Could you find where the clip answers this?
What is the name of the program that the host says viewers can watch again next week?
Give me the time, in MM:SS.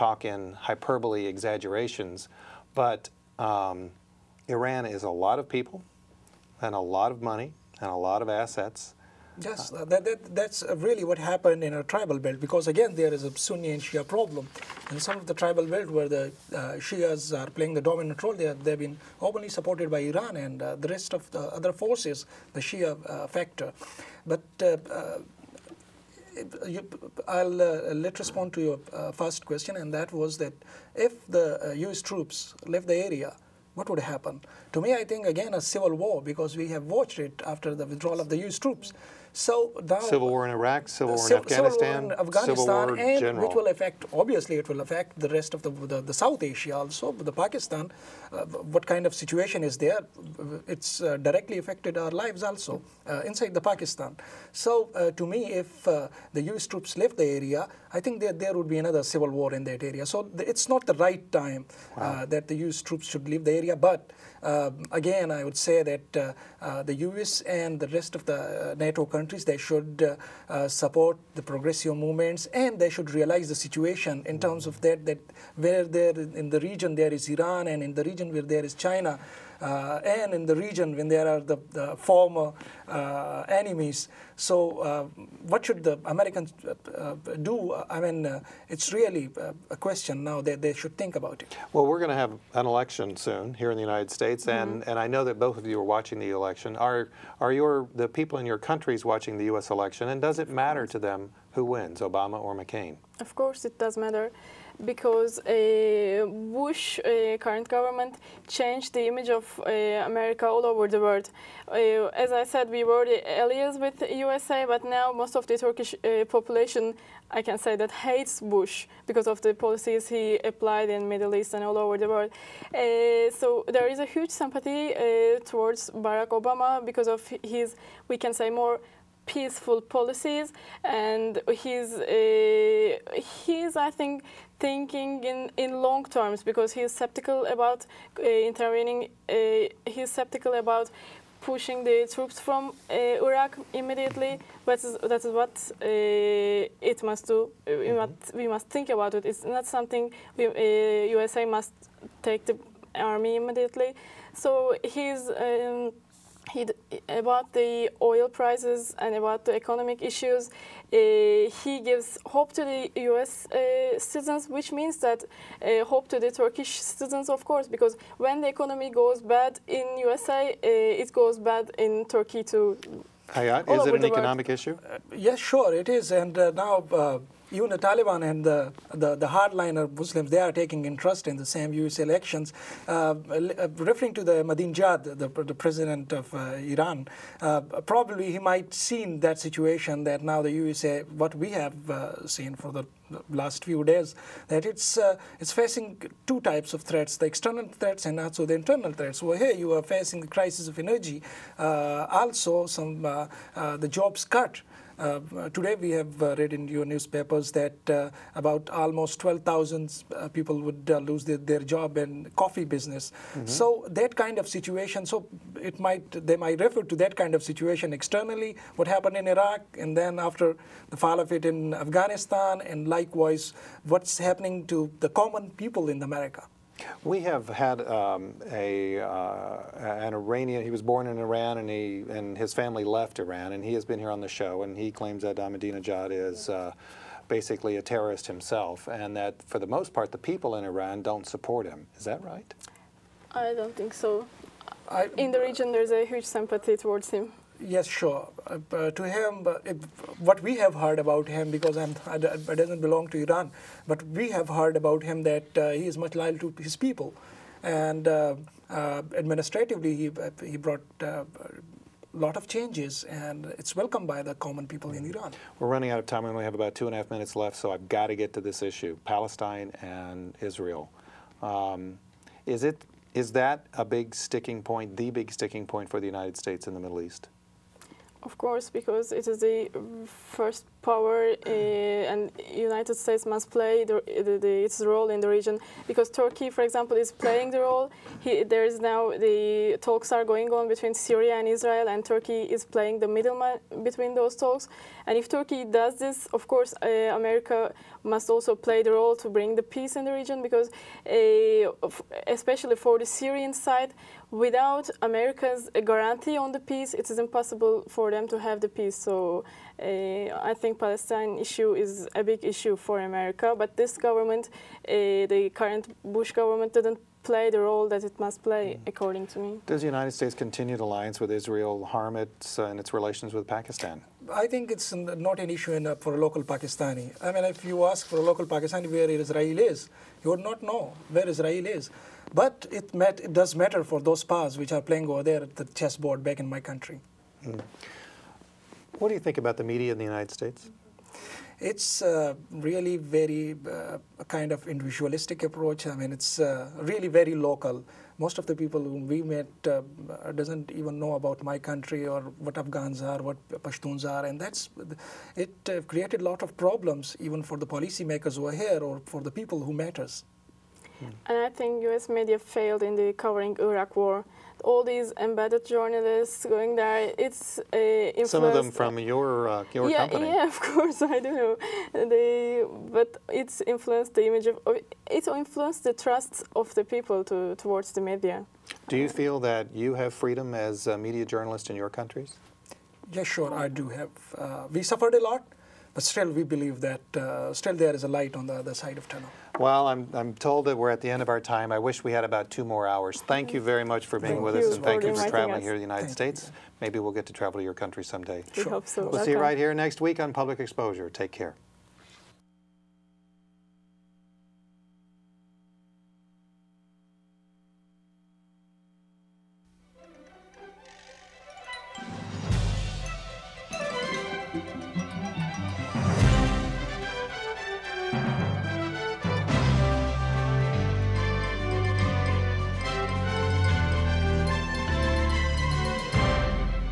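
06:40.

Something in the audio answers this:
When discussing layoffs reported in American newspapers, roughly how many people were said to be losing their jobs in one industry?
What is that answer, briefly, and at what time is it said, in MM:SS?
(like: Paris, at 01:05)
12,000, at 03:29.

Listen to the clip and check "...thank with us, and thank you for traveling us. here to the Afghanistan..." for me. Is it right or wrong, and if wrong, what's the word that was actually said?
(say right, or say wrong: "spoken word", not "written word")
wrong: "United", not "Afghanistan".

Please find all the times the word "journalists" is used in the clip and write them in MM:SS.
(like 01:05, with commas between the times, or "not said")
06:05, 06:21.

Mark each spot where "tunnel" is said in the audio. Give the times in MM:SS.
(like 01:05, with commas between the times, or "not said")
06:29.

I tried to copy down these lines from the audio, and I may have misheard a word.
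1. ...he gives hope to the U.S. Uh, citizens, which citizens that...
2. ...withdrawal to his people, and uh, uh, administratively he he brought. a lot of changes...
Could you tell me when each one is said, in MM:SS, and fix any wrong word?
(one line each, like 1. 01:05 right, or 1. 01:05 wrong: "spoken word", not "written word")
1. 02:41 wrong: "means", not "citizens"
2. 04:16 wrong: "loyal", not "withdrawal".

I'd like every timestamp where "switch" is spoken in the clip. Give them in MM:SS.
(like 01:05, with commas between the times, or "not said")
not said.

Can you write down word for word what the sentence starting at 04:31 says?
Um, is it is that a big sticking point?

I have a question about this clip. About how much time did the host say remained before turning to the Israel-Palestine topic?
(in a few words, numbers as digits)
two and a half minutes.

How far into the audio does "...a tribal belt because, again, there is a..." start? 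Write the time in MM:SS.
00:11.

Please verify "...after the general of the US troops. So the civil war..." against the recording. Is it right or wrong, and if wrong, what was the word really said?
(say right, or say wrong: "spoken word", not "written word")
wrong: "withdrawal", not "general".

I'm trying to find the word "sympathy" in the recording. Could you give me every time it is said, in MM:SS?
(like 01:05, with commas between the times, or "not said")
02:04, 04:06.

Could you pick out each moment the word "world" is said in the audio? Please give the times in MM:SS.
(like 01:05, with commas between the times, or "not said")
01:50, 02:02, 02:54.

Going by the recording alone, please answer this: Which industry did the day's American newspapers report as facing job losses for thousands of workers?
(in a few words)
coffee business.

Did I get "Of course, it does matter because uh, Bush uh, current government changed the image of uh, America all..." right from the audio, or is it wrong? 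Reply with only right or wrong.
right.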